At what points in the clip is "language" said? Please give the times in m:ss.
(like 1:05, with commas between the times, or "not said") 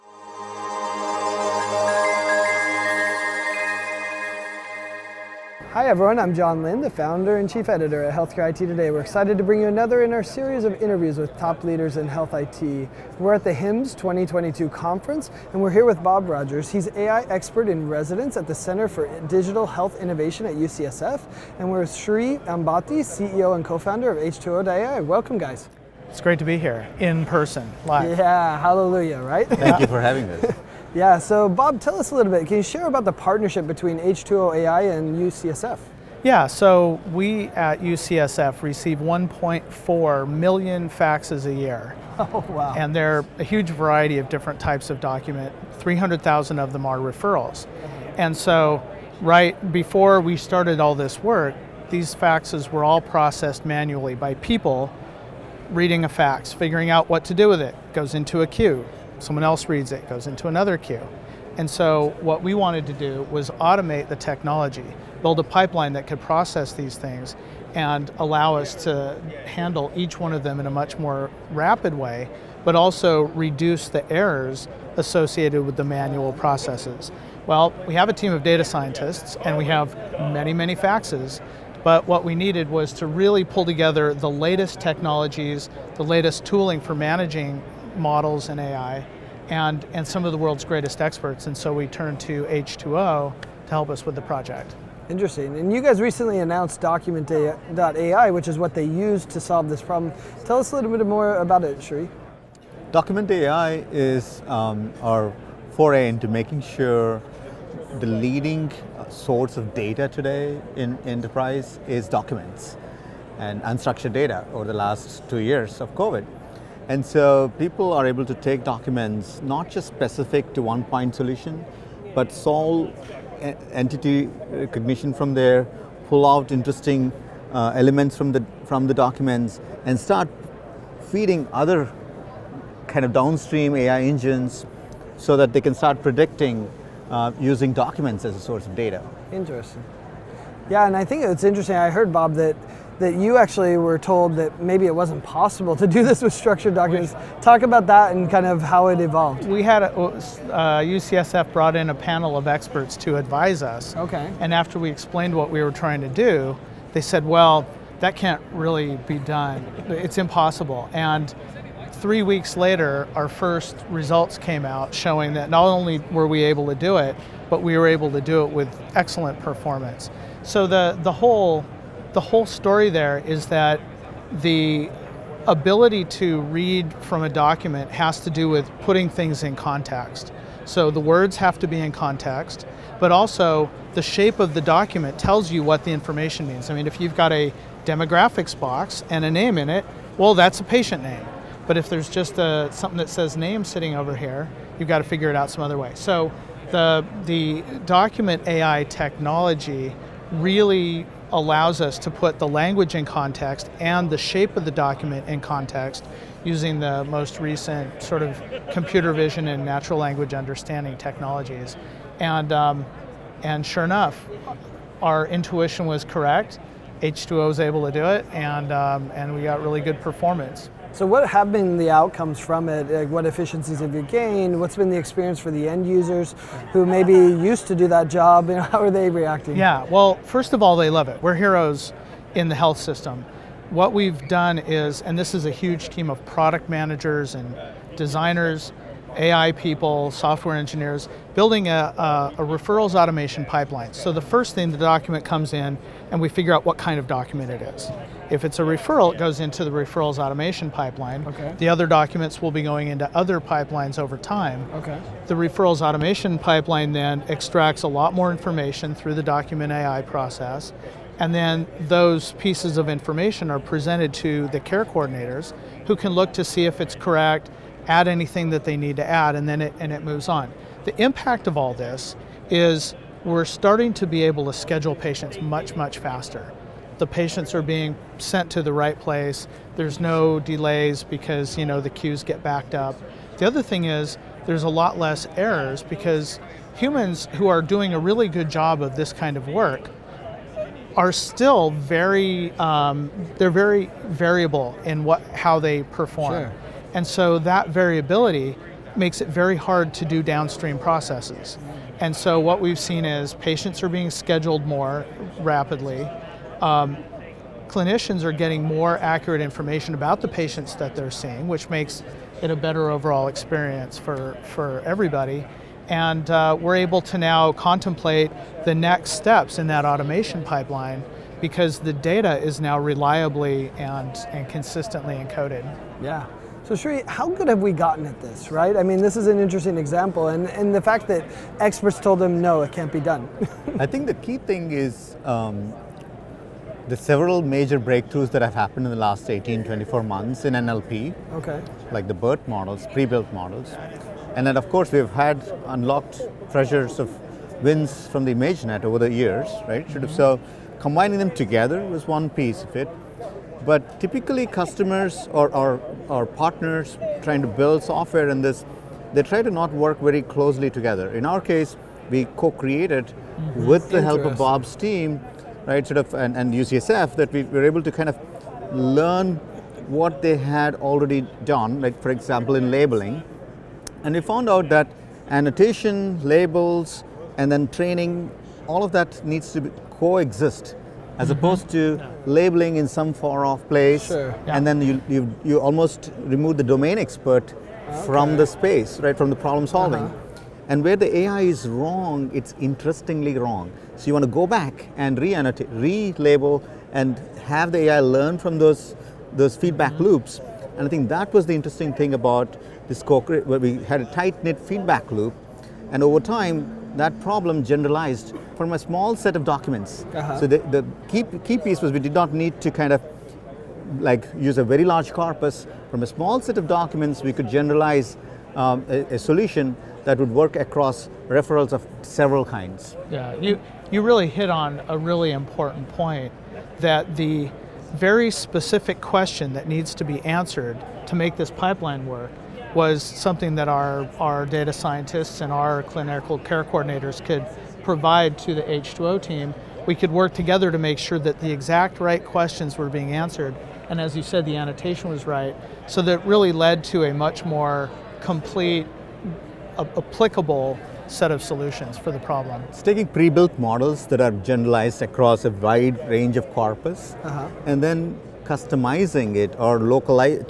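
3:22, 3:29.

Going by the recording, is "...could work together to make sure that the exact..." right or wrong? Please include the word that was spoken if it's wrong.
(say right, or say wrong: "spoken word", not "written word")
right.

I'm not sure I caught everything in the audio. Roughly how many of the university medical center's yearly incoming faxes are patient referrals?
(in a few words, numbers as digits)
300,000.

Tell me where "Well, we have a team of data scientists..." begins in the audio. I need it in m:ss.
1:17.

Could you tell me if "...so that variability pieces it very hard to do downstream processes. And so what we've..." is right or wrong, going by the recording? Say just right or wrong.
wrong.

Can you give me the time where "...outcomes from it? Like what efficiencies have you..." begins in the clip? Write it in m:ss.
3:41.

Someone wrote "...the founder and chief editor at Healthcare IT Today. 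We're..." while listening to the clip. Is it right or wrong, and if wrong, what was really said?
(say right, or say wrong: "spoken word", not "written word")
right.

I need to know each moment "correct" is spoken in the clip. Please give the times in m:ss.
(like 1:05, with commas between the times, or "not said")
3:36, 4:26.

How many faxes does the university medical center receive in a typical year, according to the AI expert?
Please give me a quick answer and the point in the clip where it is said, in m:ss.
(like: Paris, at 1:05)
1.4 million, at 0:38.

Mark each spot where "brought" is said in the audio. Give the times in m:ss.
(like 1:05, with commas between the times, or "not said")
2:31.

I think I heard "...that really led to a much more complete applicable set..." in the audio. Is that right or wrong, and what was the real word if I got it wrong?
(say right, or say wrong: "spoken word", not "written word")
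right.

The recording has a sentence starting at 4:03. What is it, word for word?
So the first thing, the document comes in, and we figure out what kind of document it is.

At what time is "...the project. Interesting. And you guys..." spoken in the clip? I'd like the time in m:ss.
1:34.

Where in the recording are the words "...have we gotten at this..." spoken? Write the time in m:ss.
5:27.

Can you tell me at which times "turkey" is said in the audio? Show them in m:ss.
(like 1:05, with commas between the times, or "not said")
not said.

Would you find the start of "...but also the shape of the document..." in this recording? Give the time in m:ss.
3:02.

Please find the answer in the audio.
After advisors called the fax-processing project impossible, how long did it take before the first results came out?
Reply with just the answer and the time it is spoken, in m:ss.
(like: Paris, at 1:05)
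three weeks, at 2:41.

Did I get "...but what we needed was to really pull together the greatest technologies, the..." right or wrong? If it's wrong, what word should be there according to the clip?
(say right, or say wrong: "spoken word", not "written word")
wrong: "latest", not "greatest".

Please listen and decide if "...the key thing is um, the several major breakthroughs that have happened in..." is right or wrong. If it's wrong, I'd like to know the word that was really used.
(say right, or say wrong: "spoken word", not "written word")
right.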